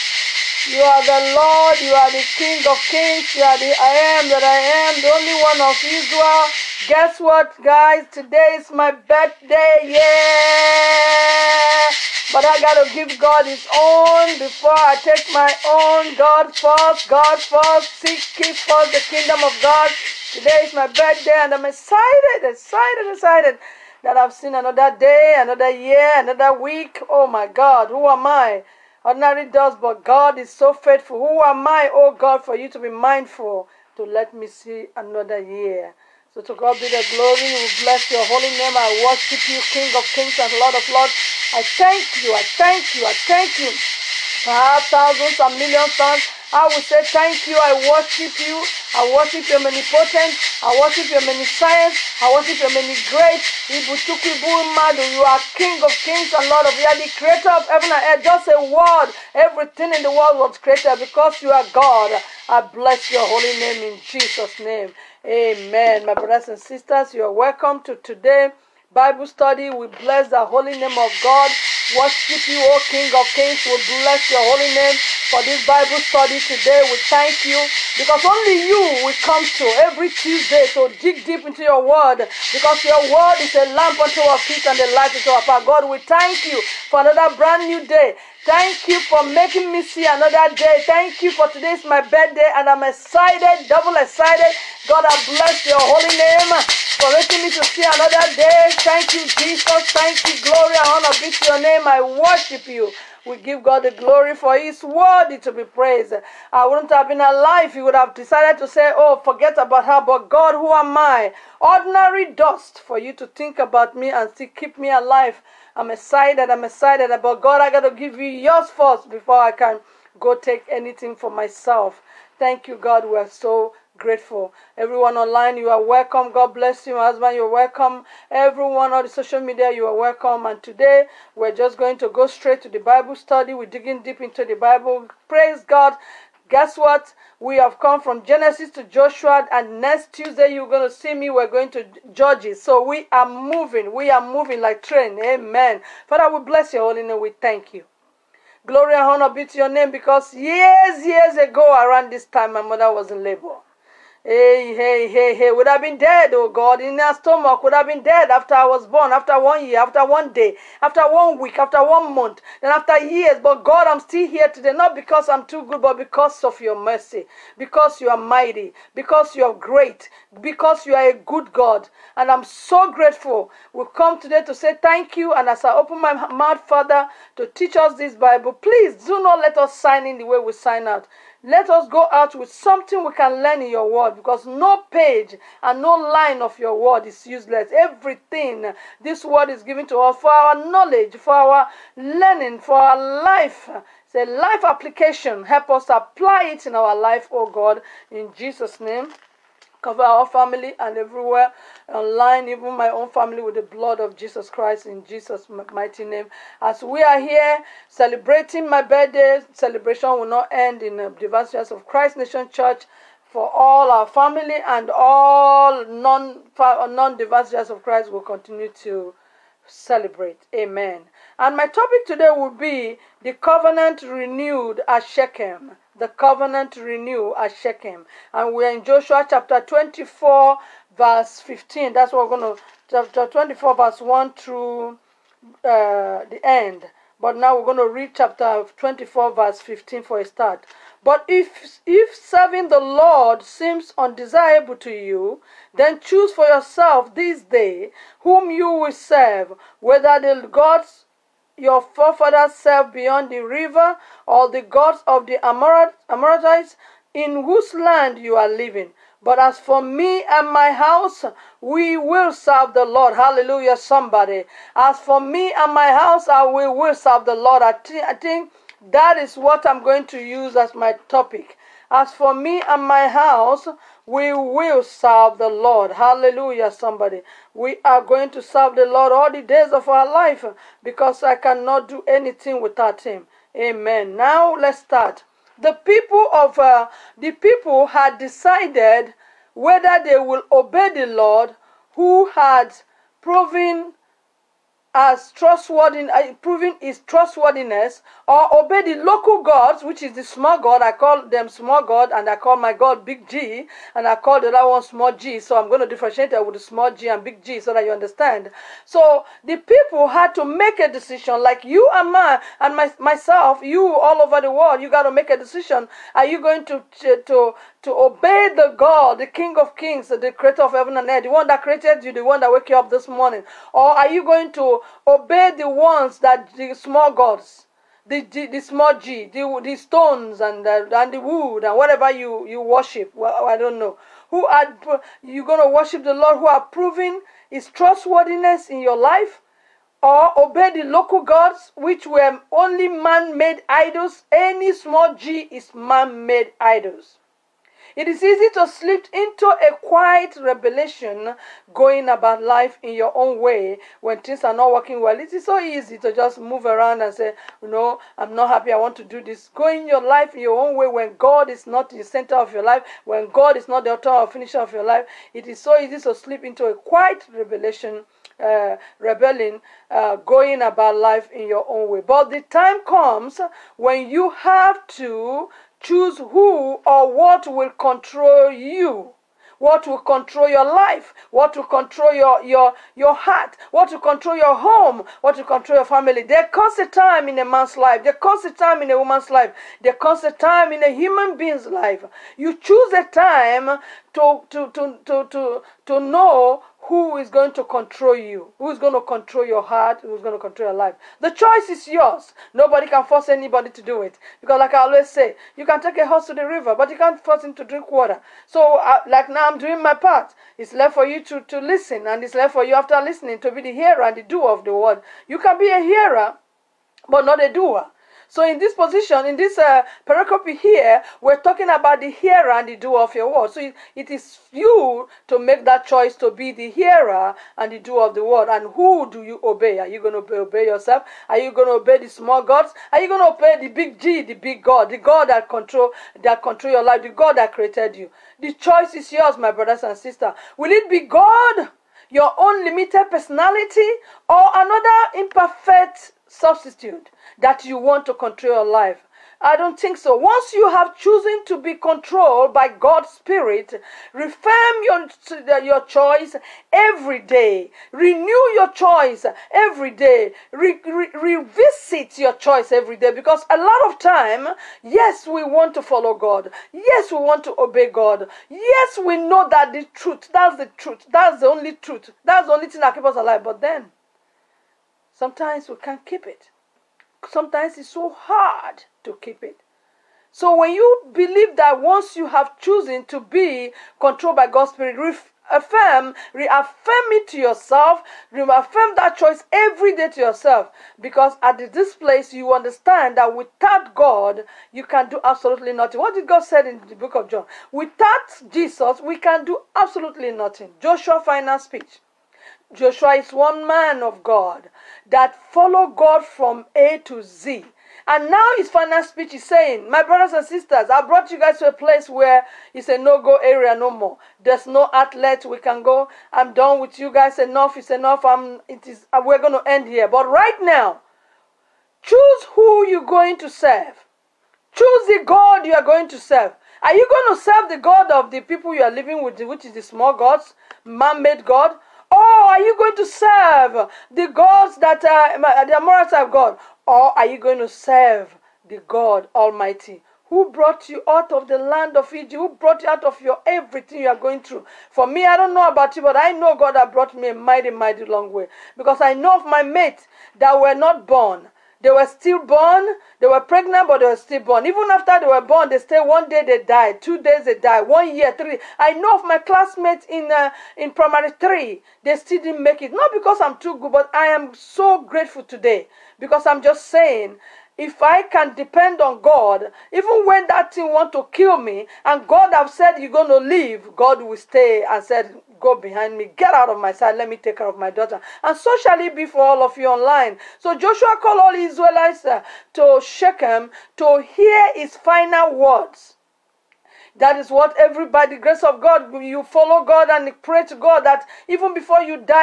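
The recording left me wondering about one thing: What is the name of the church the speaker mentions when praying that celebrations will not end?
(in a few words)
Divine of Christ Nation Church.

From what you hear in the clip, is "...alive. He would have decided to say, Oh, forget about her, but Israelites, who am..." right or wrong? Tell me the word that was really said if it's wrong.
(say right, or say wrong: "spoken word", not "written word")
wrong: "God", not "Israelites".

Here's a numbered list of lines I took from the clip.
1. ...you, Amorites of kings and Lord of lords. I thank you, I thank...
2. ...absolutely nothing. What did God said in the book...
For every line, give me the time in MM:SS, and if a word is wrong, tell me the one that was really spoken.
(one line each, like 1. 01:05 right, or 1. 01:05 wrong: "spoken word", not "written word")
1. 00:39 wrong: "King", not "Amorites"
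2. 08:15 right.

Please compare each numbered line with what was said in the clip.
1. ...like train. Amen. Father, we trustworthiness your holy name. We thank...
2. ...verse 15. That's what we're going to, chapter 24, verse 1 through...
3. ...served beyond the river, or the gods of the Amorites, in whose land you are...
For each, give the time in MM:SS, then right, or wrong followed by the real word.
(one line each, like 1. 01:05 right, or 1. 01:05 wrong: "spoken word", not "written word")
1. 02:24 wrong: "bless", not "trustworthiness"
2. 03:50 right
3. 04:12 right.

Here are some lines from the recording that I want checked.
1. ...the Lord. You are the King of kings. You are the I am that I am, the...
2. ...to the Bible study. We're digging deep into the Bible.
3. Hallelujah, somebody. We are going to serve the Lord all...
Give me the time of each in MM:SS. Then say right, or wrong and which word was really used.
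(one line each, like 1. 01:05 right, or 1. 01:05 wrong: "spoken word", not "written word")
1. 00:01 right
2. 02:12 right
3. 04:35 right.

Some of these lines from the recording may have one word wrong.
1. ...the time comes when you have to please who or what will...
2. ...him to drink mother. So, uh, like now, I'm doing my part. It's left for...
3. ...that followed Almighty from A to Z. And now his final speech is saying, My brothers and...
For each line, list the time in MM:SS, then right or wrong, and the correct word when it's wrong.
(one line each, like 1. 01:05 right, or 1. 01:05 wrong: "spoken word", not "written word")
1. 06:12 wrong: "choose", not "please"
2. 06:47 wrong: "water", not "mother"
3. 08:25 wrong: "God", not "Almighty".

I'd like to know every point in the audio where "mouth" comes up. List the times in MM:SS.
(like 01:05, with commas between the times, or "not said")
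02:56.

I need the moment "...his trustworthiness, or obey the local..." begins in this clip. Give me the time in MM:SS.
04:56.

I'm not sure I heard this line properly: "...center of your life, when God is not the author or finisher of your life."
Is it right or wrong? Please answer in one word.
right.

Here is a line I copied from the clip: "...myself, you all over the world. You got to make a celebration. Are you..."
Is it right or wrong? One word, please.
wrong.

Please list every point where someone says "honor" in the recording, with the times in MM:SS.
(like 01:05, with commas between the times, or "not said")
01:40, 02:29.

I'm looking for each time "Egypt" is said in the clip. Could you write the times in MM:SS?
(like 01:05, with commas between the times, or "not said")
09:02.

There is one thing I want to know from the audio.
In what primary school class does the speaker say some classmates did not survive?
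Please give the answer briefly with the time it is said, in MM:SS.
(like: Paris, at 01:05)
Primary three, at 09:20.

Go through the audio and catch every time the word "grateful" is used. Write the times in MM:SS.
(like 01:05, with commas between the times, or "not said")
02:03, 02:52, 09:25.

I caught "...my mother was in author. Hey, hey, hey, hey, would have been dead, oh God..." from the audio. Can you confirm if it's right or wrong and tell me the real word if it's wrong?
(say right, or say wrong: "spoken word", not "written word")
wrong: "labor", not "author".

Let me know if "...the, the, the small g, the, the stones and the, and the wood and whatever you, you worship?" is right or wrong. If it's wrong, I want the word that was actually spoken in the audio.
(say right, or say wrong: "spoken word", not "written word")
right.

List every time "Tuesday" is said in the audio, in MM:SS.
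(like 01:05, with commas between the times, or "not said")
01:20, 02:20.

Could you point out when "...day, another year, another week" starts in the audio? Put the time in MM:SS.
00:24.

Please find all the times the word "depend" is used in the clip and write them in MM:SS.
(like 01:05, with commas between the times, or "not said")
09:28.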